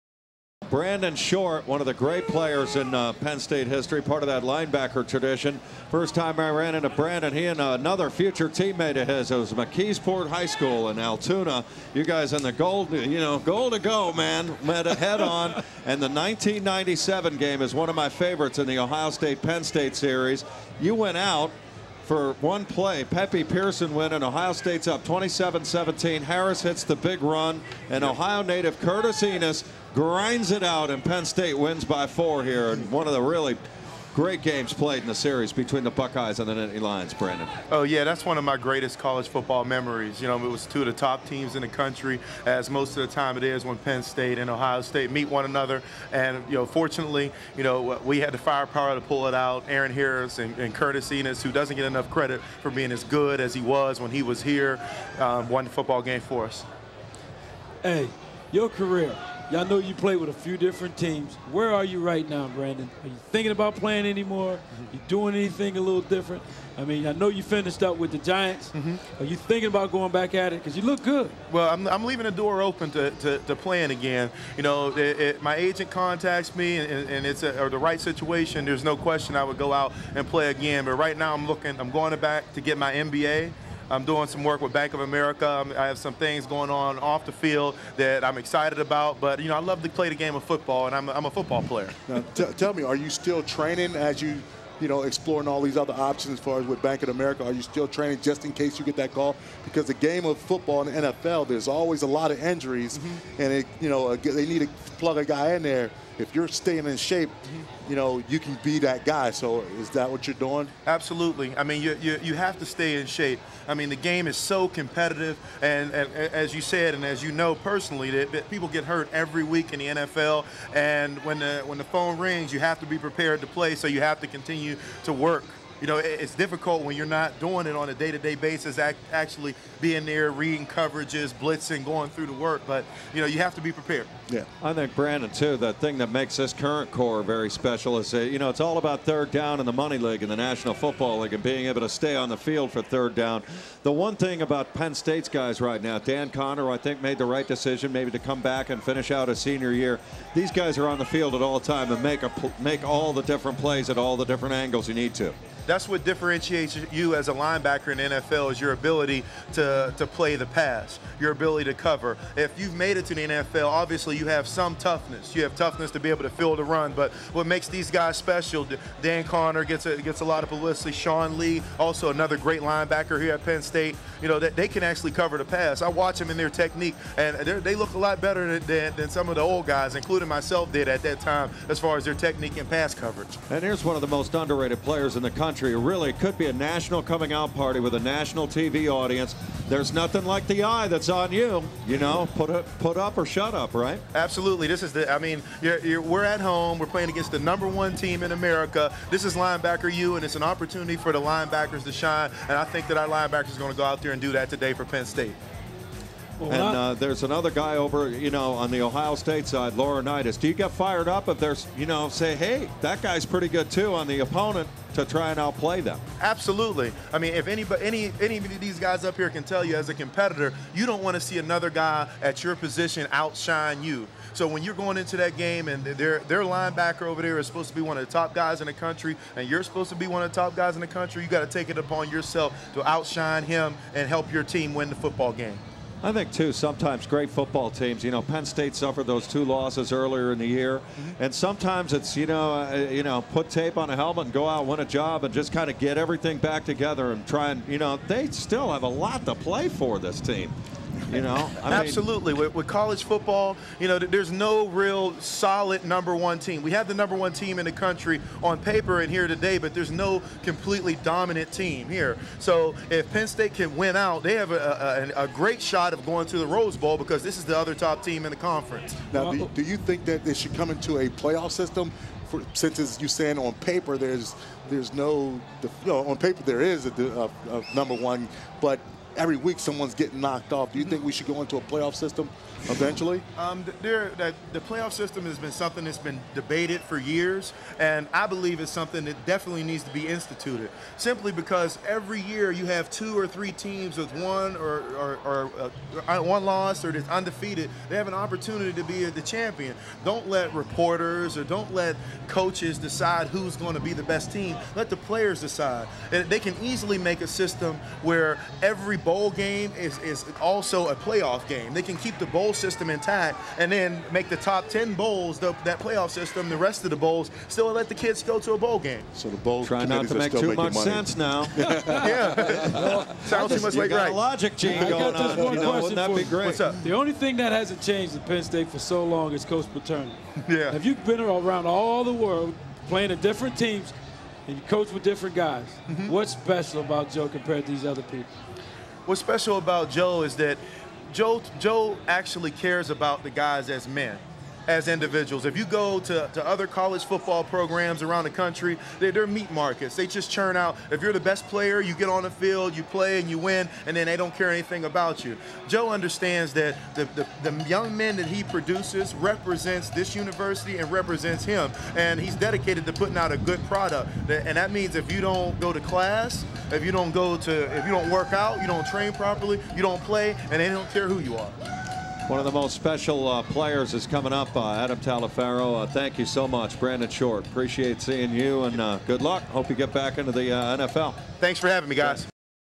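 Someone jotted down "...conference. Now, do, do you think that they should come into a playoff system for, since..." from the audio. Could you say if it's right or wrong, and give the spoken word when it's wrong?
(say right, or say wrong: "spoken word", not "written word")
right.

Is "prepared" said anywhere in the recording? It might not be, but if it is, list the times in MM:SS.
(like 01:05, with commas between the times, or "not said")
02:02, 02:13.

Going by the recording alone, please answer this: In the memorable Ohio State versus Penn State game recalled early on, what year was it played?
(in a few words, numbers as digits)
1997.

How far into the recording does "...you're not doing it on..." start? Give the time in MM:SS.
02:06.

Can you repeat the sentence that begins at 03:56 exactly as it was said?
I think, too, sometimes great football teams, you know, Penn State suffered those two losses earlier in the year.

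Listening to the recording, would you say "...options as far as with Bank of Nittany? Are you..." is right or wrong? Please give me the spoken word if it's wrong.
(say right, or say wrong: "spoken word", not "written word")
wrong: "America", not "Nittany".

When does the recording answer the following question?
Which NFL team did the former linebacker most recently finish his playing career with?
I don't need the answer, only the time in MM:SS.
01:08.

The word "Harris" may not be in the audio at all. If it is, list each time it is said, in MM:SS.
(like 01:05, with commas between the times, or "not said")
00:26, 00:49.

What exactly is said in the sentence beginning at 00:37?
Oh, yeah, that's one of my greatest college football memories.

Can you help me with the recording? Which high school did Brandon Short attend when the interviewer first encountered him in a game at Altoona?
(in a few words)
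McKeesport High School.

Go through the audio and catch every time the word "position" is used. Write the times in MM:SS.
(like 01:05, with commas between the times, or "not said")
03:42.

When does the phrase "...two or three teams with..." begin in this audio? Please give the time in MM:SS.
04:52.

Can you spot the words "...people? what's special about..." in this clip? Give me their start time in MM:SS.
05:38.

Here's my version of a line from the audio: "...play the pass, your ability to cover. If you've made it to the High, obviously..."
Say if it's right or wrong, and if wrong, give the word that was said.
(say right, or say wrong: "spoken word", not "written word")
wrong: "NFL", not "High".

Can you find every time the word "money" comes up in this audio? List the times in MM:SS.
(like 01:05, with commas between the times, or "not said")
02:19, 05:20.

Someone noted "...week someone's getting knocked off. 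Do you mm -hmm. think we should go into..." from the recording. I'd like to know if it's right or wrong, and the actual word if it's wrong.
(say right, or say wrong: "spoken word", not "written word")
right.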